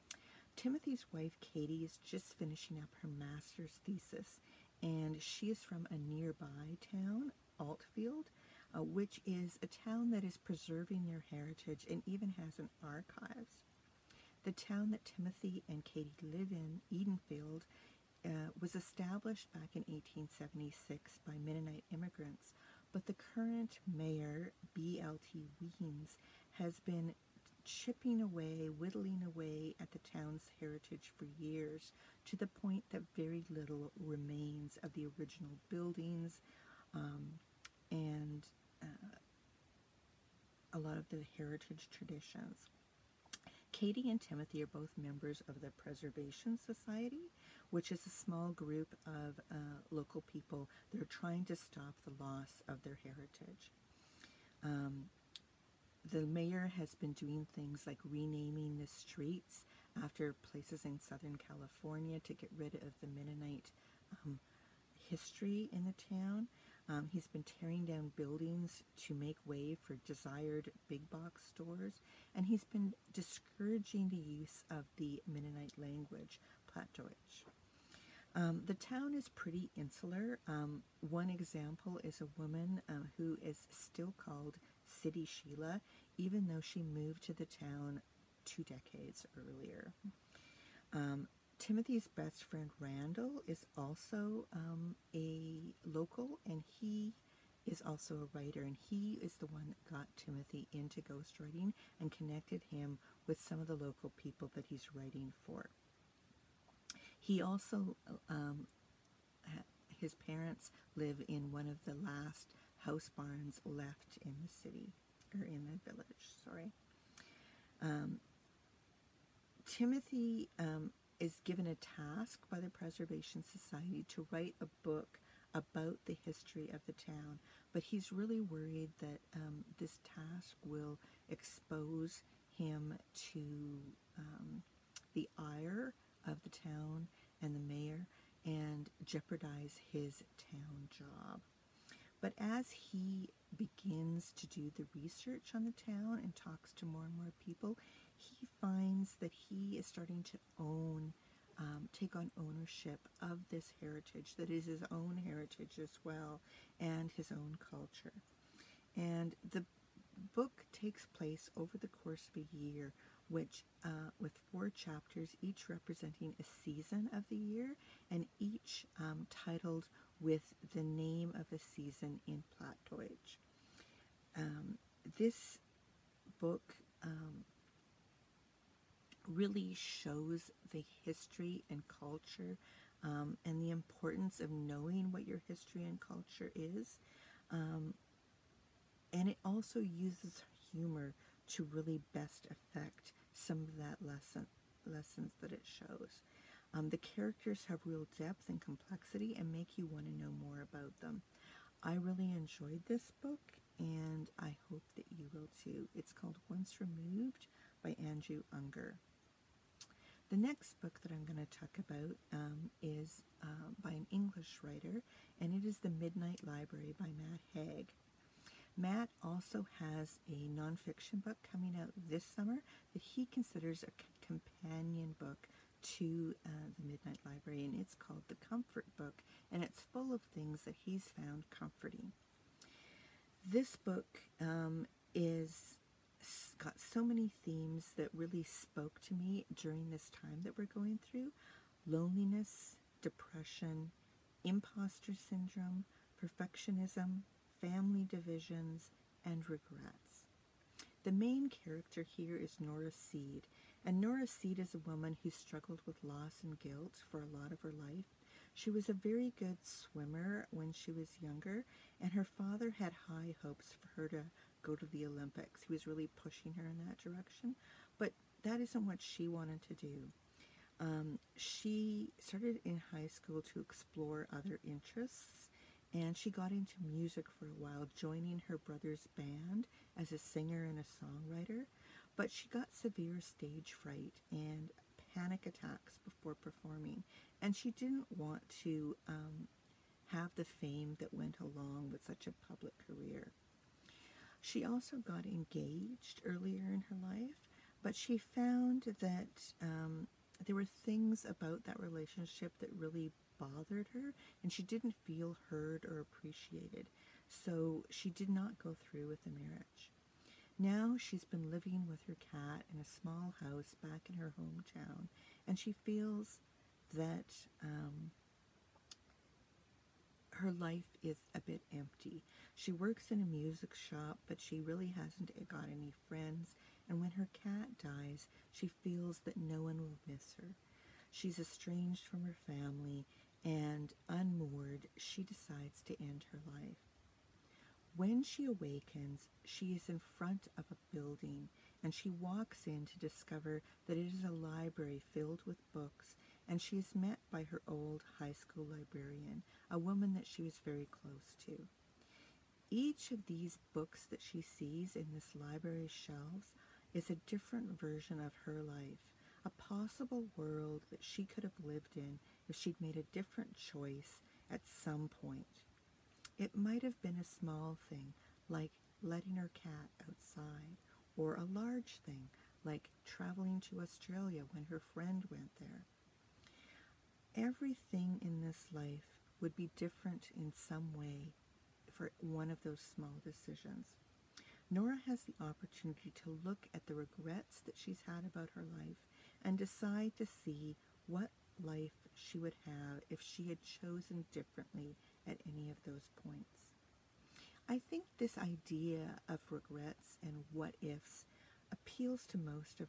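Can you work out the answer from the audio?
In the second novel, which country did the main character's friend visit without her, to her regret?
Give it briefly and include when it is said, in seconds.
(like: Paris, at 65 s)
Australia, at 373 s.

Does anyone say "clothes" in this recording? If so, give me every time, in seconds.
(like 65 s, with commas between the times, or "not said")
not said.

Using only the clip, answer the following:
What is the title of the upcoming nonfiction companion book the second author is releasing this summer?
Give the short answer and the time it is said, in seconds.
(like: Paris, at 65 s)
The Comfort Book, at 228 s.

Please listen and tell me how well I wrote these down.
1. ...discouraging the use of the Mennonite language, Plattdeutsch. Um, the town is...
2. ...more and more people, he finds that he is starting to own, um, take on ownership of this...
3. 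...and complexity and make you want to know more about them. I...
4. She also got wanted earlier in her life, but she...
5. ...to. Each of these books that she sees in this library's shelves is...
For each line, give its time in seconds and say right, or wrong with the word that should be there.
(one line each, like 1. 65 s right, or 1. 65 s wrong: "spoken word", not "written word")
1. 73 s right
2. 146 s right
3. 198 s right
4. 294 s wrong: "engaged", not "wanted"
5. 351 s right.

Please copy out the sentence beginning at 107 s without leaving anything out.
He also, um, his parents live in one of the last house barns left in the city, or in the village, sorry.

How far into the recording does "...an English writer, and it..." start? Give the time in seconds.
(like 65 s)
213 s.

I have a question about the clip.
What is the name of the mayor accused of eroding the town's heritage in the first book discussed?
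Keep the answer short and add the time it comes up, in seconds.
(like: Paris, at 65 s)
BLT Weems, at 24 s.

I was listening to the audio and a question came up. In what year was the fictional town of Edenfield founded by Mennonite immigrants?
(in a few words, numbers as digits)
1876.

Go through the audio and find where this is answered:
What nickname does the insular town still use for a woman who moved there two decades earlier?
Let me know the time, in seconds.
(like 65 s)
84 s.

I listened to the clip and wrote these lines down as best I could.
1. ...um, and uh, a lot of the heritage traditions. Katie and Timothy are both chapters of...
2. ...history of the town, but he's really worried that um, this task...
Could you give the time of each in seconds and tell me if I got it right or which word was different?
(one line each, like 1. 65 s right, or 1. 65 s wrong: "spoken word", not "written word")
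1. 36 s wrong: "members", not "chapters"
2. 126 s right.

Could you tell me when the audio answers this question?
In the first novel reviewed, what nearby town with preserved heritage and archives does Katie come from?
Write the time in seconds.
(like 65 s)
7 s.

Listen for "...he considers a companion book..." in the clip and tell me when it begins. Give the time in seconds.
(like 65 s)
223 s.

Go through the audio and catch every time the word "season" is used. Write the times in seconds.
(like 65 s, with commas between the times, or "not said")
166 s, 171 s.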